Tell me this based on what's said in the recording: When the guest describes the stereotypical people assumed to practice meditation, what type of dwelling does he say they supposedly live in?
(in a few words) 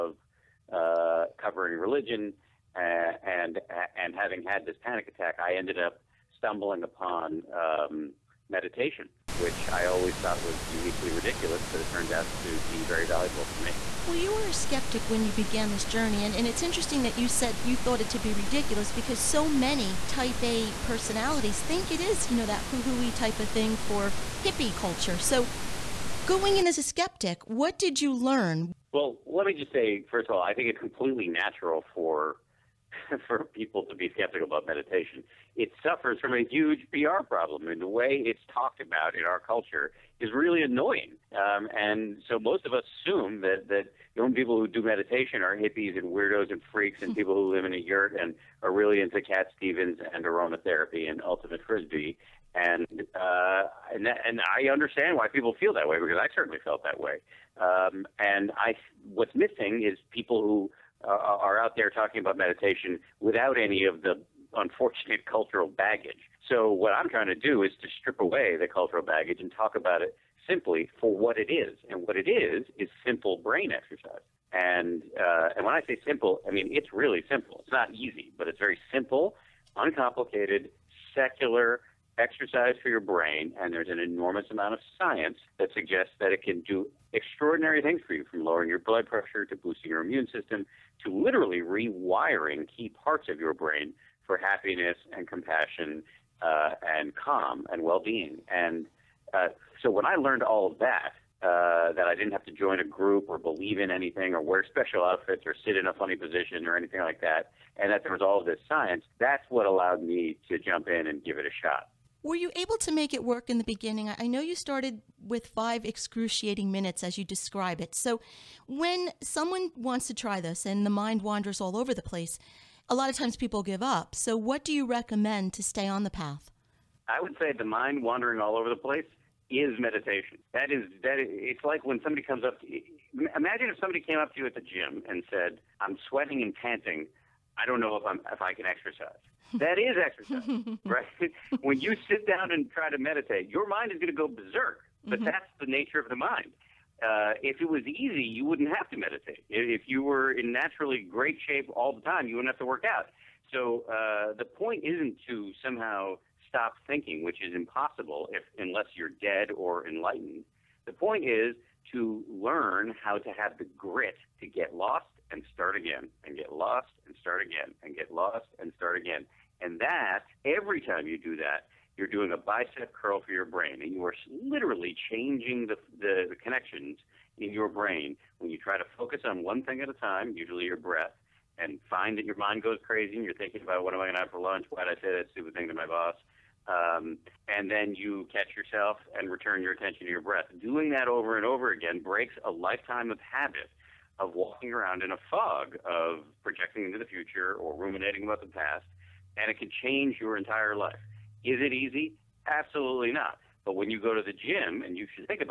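a yurt.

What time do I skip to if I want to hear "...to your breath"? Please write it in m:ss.
3:10.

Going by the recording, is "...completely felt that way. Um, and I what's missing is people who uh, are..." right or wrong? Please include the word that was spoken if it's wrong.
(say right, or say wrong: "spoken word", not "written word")
wrong: "certainly", not "completely".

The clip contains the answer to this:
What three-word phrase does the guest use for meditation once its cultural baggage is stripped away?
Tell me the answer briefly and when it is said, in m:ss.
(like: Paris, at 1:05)
simple brain exercise, at 1:13.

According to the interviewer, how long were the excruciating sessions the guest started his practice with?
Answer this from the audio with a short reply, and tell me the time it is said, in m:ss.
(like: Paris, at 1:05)
5 minutes, at 1:55.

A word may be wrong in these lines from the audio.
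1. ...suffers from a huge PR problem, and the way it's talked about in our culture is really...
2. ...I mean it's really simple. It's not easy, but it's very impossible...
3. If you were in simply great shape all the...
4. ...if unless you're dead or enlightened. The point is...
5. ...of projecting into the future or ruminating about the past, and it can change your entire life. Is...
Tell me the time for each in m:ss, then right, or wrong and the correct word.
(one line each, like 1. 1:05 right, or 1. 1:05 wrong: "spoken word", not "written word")
1. 0:35 right
2. 1:16 wrong: "simple", not "impossible"
3. 2:29 wrong: "naturally", not "simply"
4. 2:38 right
5. 3:15 right.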